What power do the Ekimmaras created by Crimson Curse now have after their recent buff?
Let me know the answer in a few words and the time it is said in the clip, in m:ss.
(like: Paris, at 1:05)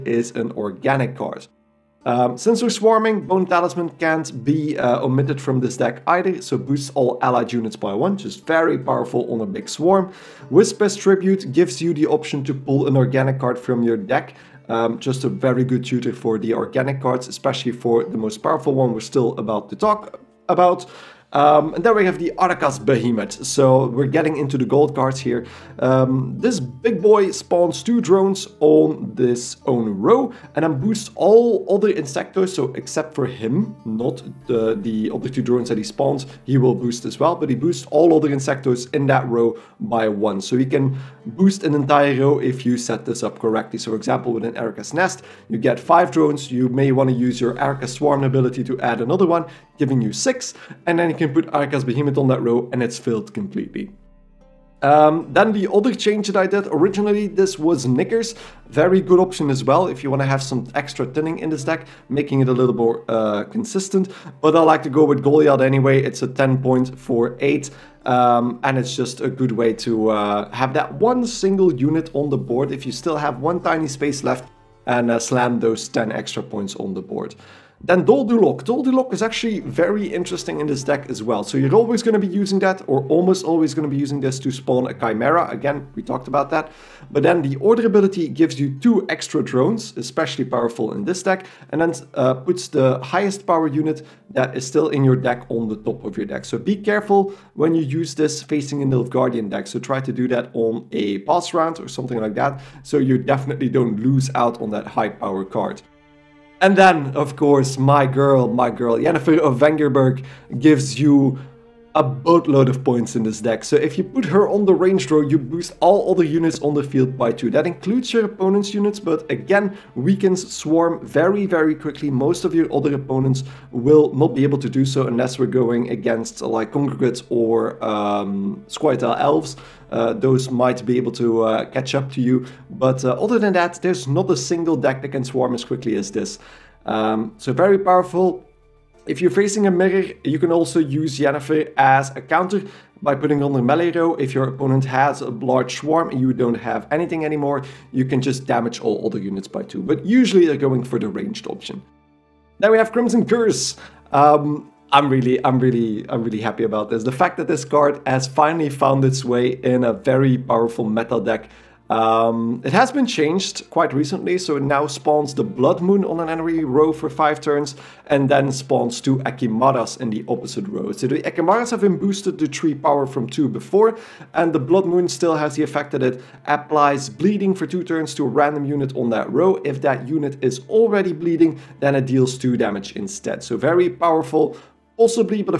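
3, at 2:52.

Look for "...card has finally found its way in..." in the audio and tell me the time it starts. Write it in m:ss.
2:37.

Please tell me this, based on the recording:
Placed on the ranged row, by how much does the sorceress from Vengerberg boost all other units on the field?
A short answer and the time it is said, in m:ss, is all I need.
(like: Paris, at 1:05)
2, at 1:57.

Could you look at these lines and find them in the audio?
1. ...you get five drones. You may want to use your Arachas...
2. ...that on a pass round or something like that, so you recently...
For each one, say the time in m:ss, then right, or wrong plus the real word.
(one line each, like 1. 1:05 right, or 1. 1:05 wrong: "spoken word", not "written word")
1. 0:45 right
2. 1:40 wrong: "definitely", not "recently".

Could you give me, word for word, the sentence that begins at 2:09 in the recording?
Uh, those might be able to uh, catch up to you.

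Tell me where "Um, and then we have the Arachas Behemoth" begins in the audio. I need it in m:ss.
0:21.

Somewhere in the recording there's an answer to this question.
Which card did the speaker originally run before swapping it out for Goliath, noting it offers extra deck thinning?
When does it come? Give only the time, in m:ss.
0:57.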